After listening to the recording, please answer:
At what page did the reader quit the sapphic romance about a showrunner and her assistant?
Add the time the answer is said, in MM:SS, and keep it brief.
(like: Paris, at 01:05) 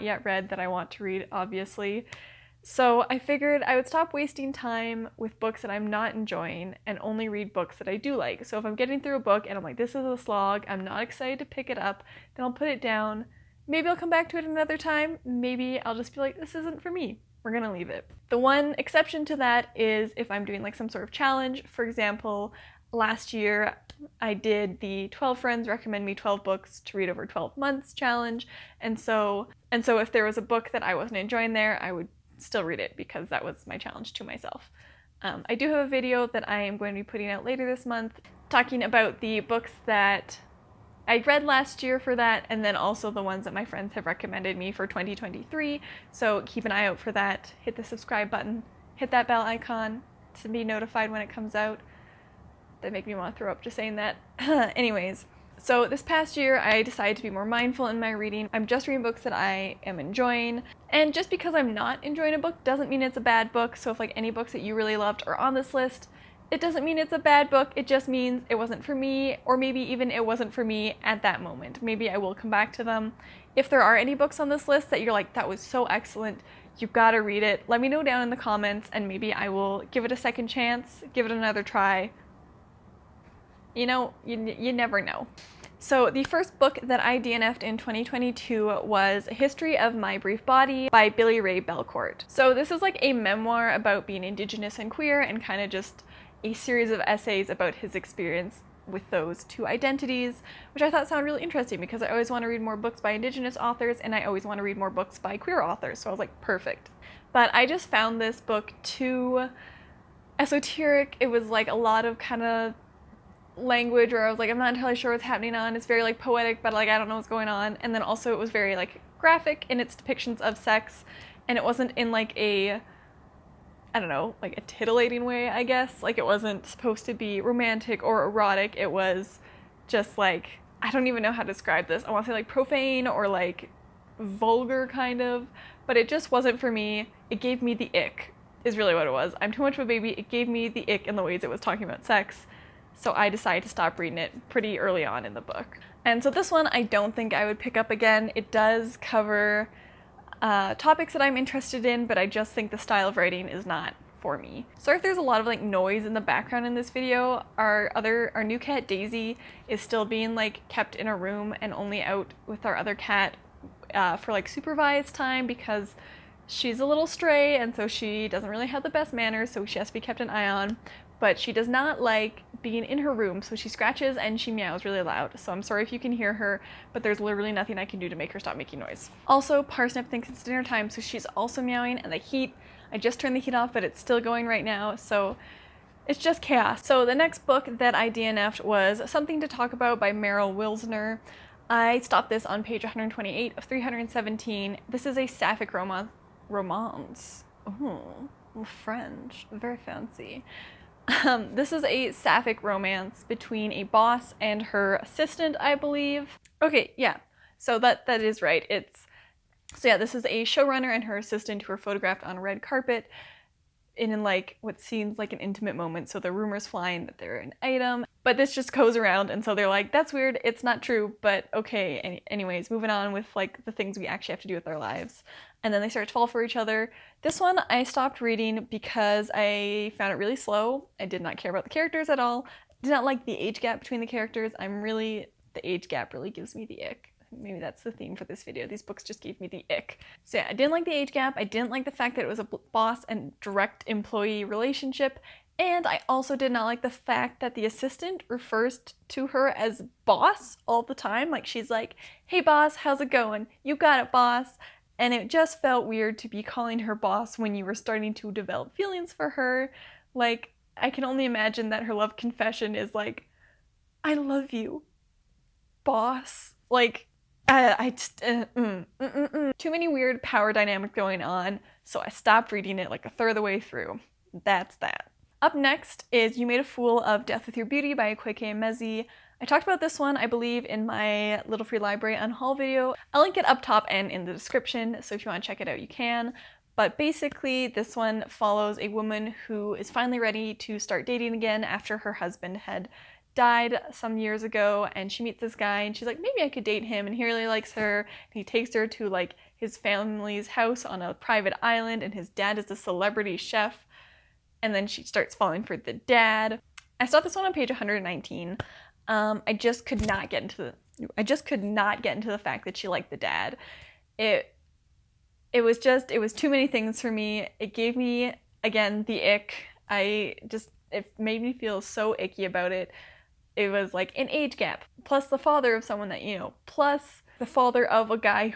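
128, at 03:12.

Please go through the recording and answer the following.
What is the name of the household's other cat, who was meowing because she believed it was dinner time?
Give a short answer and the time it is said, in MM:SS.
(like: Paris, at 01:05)
Parsnip, at 02:59.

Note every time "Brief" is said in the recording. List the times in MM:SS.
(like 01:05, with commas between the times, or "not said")
01:30.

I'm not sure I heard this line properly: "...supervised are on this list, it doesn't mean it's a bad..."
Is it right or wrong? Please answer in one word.
wrong.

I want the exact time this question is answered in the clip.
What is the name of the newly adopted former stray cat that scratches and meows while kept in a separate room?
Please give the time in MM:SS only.
02:38.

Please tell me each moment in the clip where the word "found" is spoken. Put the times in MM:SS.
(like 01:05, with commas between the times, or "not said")
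01:47, 03:49.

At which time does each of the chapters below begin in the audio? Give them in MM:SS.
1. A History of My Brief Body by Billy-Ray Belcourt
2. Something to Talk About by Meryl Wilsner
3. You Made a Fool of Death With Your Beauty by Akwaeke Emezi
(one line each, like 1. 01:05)
1. 01:25
2. 03:06
3. 04:35.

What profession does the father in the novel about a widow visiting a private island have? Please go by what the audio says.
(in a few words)
Celebrity chef.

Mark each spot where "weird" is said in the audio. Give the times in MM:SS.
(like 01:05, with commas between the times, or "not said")
03:40, 04:15, 04:29.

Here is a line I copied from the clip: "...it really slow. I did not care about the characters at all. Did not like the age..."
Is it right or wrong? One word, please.
right.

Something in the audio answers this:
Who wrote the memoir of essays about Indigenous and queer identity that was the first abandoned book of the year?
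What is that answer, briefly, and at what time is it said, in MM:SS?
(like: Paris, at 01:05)
Billy Ray Belcourt, at 01:31.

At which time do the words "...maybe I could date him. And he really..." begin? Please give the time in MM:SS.
04:56.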